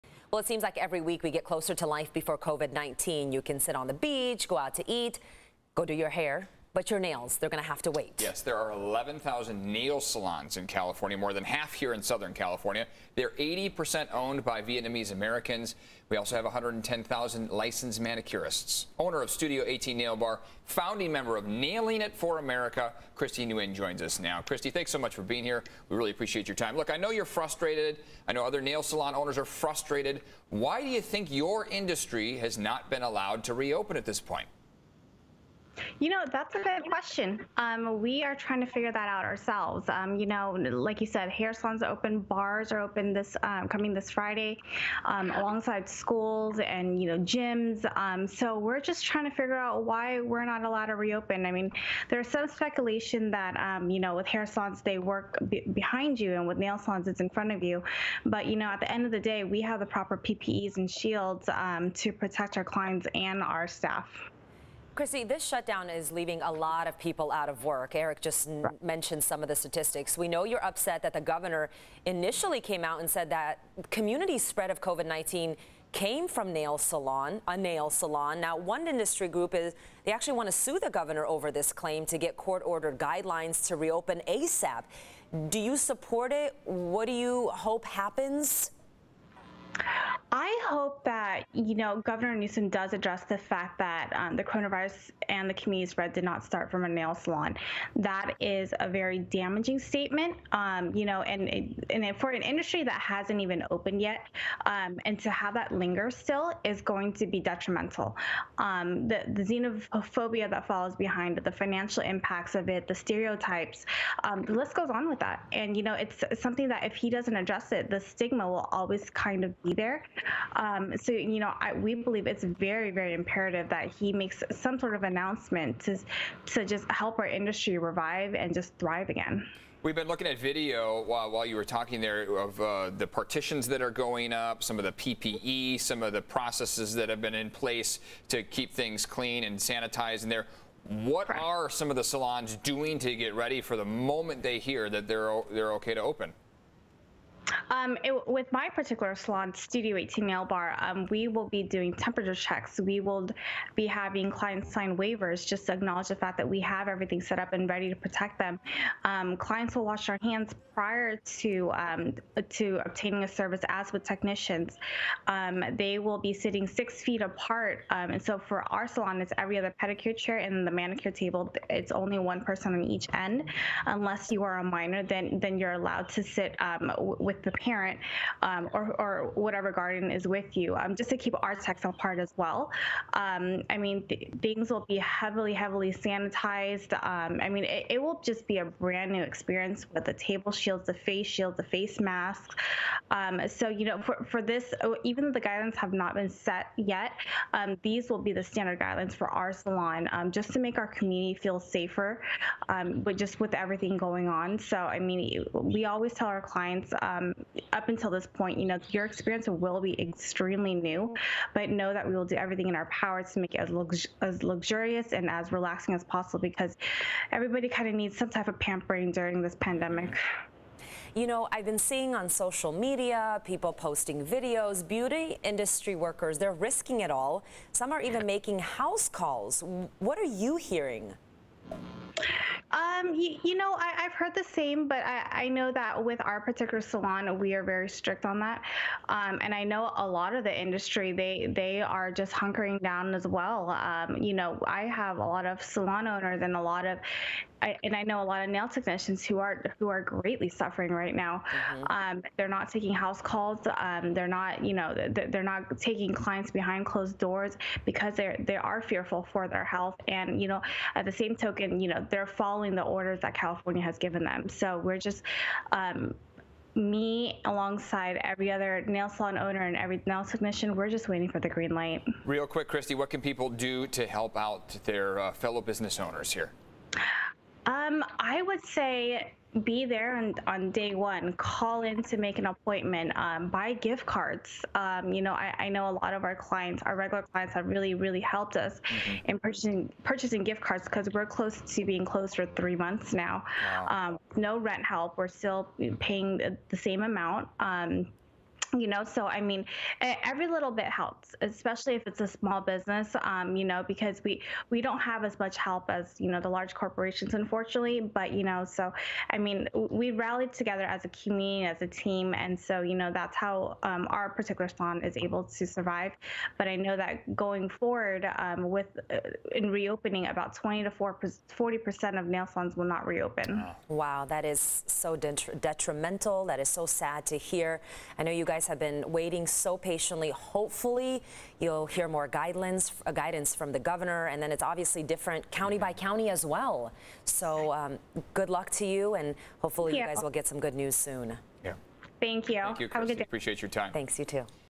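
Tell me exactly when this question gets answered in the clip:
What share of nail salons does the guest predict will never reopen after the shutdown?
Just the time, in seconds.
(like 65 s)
320 s.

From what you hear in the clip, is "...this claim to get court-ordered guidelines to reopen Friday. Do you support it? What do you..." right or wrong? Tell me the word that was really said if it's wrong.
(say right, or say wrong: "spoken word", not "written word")
wrong: "ASAP", not "Friday".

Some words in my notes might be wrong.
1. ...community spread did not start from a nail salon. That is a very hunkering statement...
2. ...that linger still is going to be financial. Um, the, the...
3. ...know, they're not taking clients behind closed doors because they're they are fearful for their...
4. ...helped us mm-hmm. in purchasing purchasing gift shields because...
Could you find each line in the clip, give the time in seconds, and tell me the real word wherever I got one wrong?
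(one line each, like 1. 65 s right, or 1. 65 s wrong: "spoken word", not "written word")
1. 95 s wrong: "damaging", not "hunkering"
2. 105 s wrong: "detrimental", not "financial"
3. 254 s right
4. 288 s wrong: "cards", not "shields".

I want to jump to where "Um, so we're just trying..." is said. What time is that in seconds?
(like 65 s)
47 s.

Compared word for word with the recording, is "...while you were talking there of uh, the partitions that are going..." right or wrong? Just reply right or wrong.
right.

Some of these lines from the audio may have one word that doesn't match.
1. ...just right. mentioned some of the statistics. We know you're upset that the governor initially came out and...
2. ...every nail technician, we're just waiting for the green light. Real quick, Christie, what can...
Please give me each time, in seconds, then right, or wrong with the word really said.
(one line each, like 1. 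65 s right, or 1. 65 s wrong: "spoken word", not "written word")
1. 68 s right
2. 269 s right.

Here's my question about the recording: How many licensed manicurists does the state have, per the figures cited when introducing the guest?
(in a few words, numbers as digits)
110,000.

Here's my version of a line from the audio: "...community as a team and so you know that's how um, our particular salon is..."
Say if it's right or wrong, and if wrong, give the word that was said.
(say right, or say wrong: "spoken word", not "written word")
right.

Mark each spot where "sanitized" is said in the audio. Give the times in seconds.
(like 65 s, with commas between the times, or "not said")
139 s, 185 s.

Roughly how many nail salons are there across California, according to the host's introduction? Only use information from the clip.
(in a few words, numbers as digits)
11,000.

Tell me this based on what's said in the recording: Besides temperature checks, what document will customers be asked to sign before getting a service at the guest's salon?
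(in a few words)
Waivers.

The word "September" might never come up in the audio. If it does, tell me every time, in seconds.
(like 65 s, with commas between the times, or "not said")
not said.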